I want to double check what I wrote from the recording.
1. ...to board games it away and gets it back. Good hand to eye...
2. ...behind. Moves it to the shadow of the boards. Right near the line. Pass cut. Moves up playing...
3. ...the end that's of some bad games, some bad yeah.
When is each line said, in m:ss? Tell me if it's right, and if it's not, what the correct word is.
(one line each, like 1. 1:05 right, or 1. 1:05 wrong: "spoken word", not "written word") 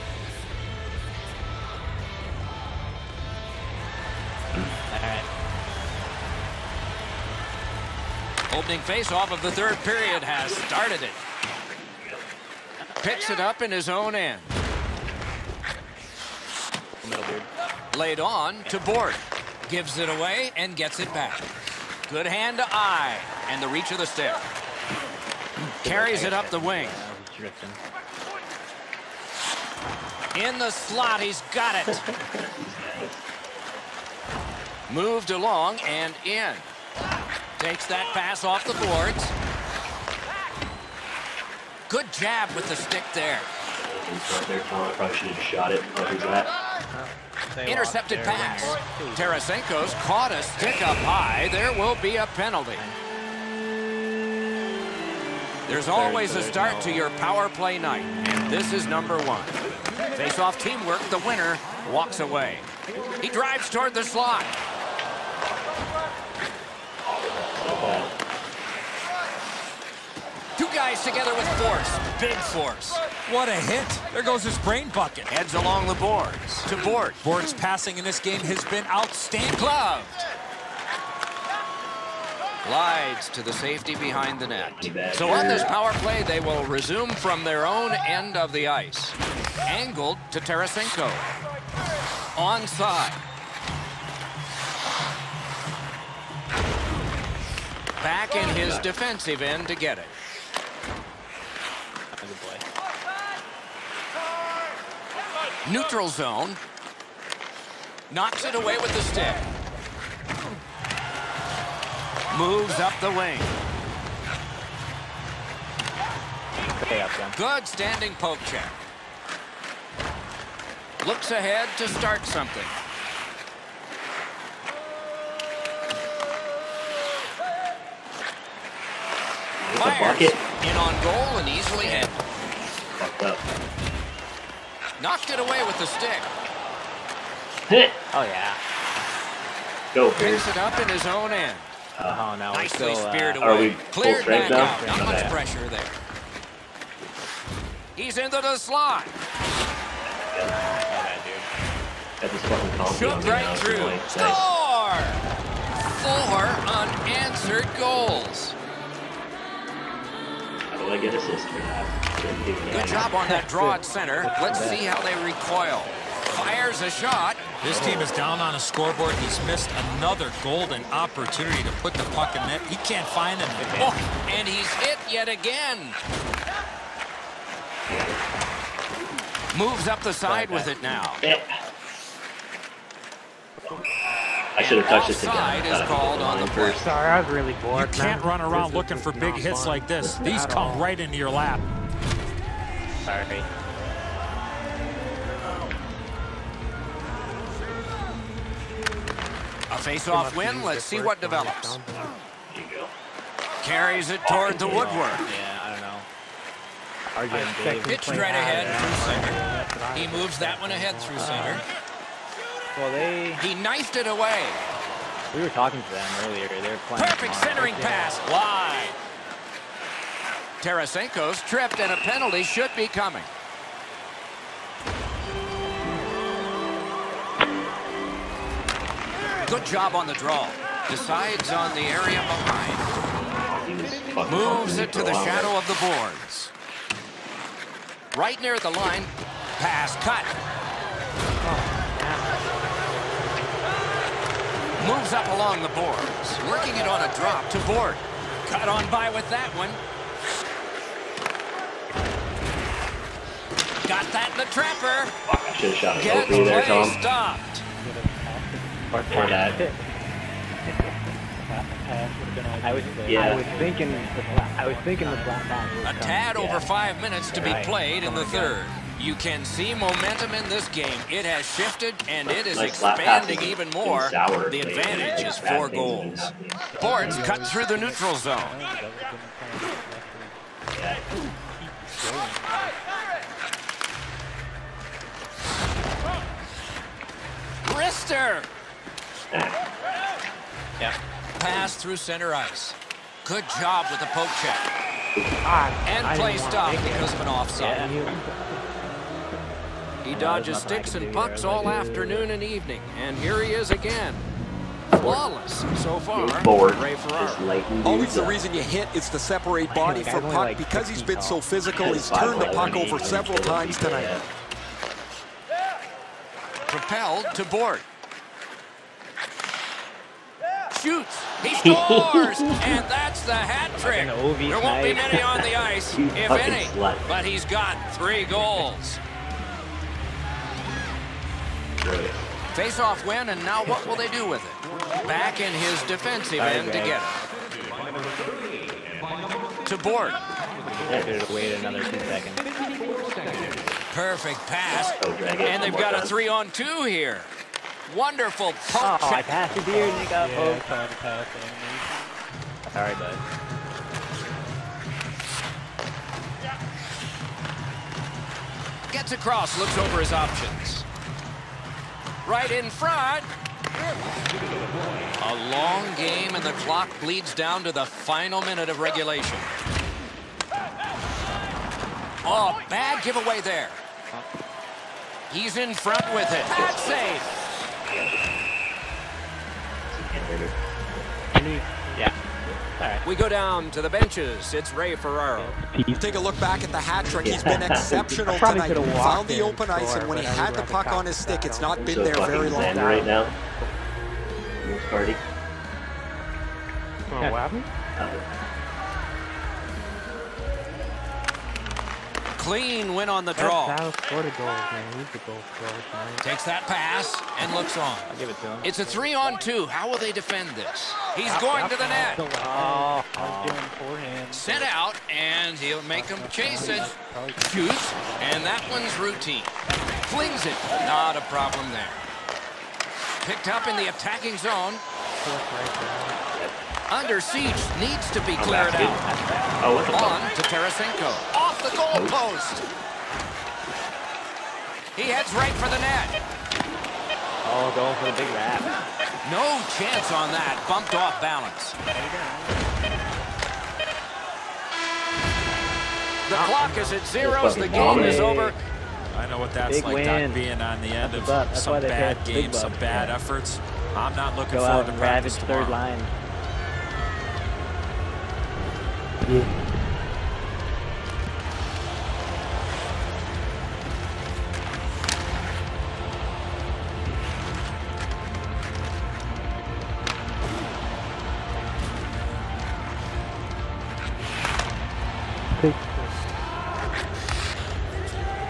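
1. 0:18 wrong: "gives", not "games"
2. 3:52 wrong: "along", not "playing"
3. 7:30 right.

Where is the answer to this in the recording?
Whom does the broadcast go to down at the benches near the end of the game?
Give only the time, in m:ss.
6:24.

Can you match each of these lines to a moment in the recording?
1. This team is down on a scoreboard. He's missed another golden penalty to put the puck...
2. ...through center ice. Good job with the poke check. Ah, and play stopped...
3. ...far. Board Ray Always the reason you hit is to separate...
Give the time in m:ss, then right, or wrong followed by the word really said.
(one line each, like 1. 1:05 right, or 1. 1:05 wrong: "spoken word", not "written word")
1. 2:47 wrong: "opportunity", not "penalty"
2. 4:51 right
3. 5:05 right.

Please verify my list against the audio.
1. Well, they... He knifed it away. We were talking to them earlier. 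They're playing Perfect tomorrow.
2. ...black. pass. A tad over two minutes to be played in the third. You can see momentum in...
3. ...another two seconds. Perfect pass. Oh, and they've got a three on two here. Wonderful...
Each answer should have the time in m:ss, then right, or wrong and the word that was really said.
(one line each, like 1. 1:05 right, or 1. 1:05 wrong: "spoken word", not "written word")
1. 3:32 right
2. 4:25 wrong: "five", not "two"
3. 5:41 right.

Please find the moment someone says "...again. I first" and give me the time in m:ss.
3:05.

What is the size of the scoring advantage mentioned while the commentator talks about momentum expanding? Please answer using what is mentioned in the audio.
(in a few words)
4 goals.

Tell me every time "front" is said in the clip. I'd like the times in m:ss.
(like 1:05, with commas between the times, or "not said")
6:02, 6:15.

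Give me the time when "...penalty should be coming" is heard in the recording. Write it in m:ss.
3:41.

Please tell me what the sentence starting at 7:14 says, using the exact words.
He heads right for the net.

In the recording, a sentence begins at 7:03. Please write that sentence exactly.
Picked up in the attacking zone.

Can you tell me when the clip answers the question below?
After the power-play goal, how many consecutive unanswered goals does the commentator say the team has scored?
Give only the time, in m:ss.
2:36.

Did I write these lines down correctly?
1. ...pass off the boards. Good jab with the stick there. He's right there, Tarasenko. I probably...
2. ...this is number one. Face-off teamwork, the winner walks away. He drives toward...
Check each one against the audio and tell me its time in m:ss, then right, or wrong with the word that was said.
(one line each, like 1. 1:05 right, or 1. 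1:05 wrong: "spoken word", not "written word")
1. 0:38 wrong: "Tom", not "Tarasenko"
2. 0:58 right.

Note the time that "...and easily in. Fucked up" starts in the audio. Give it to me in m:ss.
2:11.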